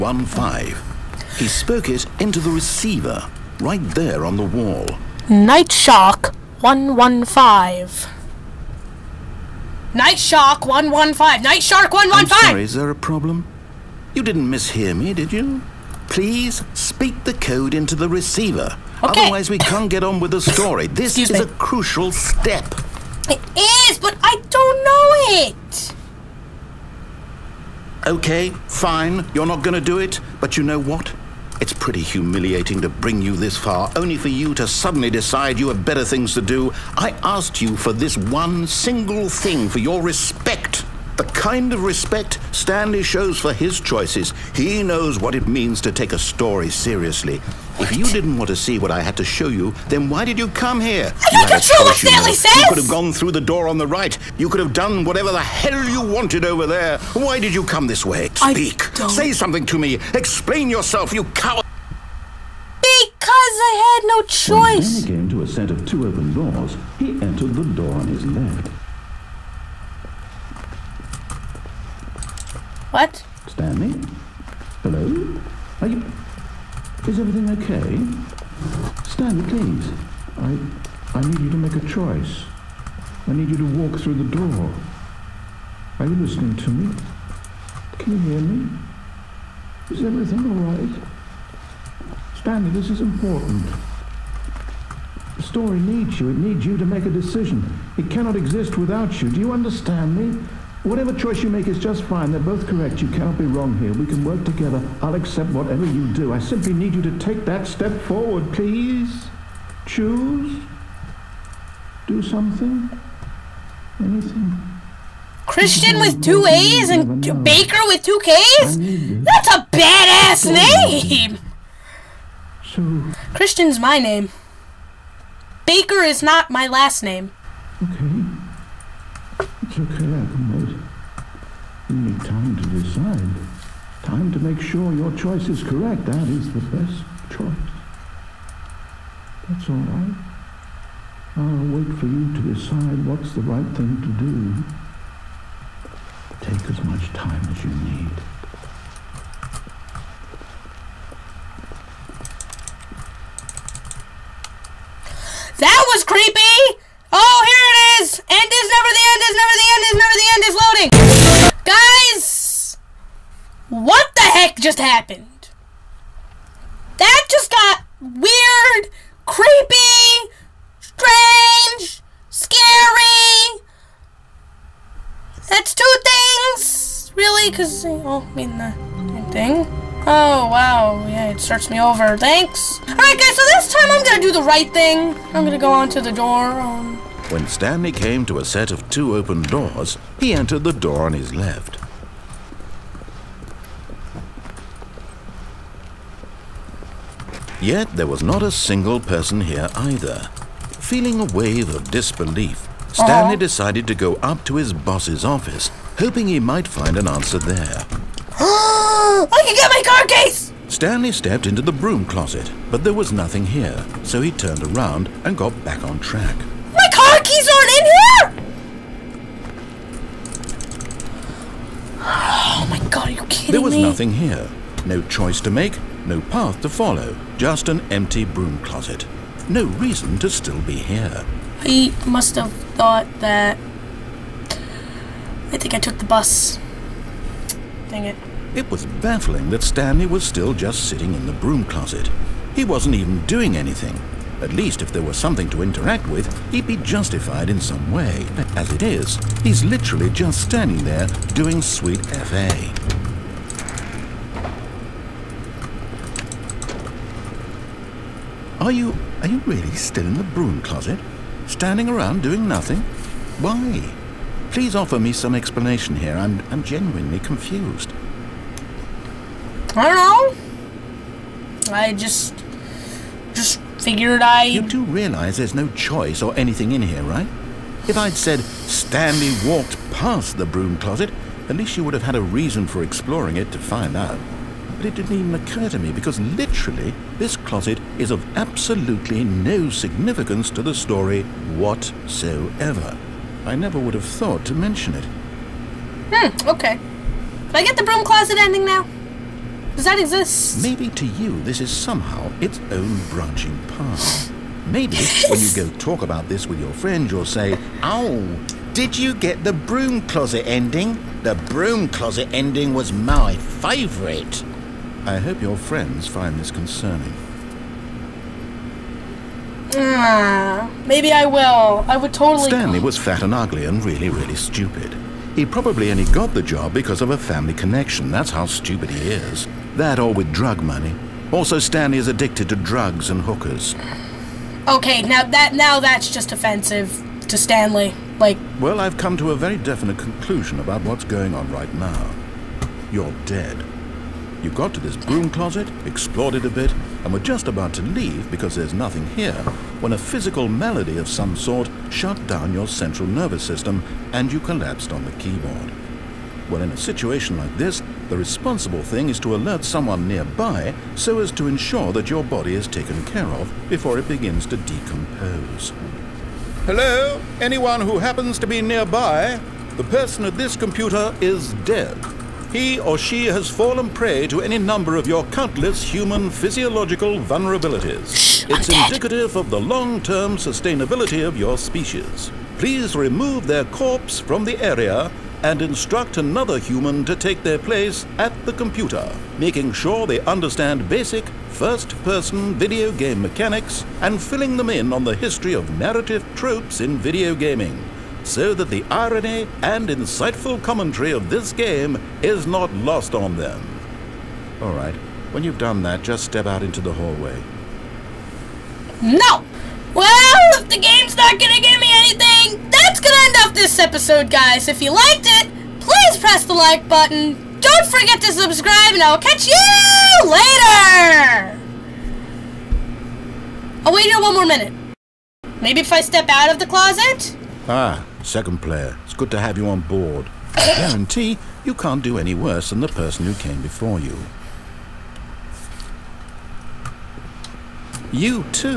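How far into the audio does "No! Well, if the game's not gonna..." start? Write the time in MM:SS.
06:49.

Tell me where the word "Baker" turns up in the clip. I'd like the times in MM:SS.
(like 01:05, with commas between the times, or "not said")
01:57, 02:05.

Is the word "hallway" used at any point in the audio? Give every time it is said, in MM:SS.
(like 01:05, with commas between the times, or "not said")
06:46.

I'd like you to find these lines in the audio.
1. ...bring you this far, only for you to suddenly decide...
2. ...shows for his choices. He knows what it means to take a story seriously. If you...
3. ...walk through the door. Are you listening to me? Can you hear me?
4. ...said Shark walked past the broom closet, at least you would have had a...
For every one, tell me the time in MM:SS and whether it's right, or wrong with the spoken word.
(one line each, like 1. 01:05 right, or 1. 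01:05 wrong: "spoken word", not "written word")
1. 00:32 right
2. 00:43 right
3. 01:23 right
4. 04:38 wrong: "Stanley", not "Shark".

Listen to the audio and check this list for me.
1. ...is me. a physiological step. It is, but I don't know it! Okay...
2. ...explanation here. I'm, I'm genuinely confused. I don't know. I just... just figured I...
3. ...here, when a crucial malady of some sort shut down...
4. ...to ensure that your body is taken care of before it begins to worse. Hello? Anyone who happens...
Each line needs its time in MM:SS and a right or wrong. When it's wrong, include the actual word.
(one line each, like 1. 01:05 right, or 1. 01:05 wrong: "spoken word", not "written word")
1. 00:21 wrong: "crucial", not "physiological"
2. 04:25 right
3. 05:49 wrong: "physical", not "crucial"
4. 06:01 wrong: "decompose", not "worse".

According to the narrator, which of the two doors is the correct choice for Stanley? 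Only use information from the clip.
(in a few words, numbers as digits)
Both.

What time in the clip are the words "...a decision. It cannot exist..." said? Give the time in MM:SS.
01:37.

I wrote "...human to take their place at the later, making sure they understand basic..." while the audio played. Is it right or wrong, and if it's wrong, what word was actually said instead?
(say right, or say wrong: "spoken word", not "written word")
wrong: "computer", not "later".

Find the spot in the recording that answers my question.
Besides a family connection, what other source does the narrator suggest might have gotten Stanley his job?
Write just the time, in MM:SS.
05:30.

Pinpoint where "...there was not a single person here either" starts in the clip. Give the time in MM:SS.
03:17.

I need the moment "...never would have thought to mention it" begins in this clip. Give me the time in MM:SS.
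04:53.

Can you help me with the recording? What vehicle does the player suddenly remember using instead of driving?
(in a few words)
The bus.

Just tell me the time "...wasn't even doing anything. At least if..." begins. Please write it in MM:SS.
04:02.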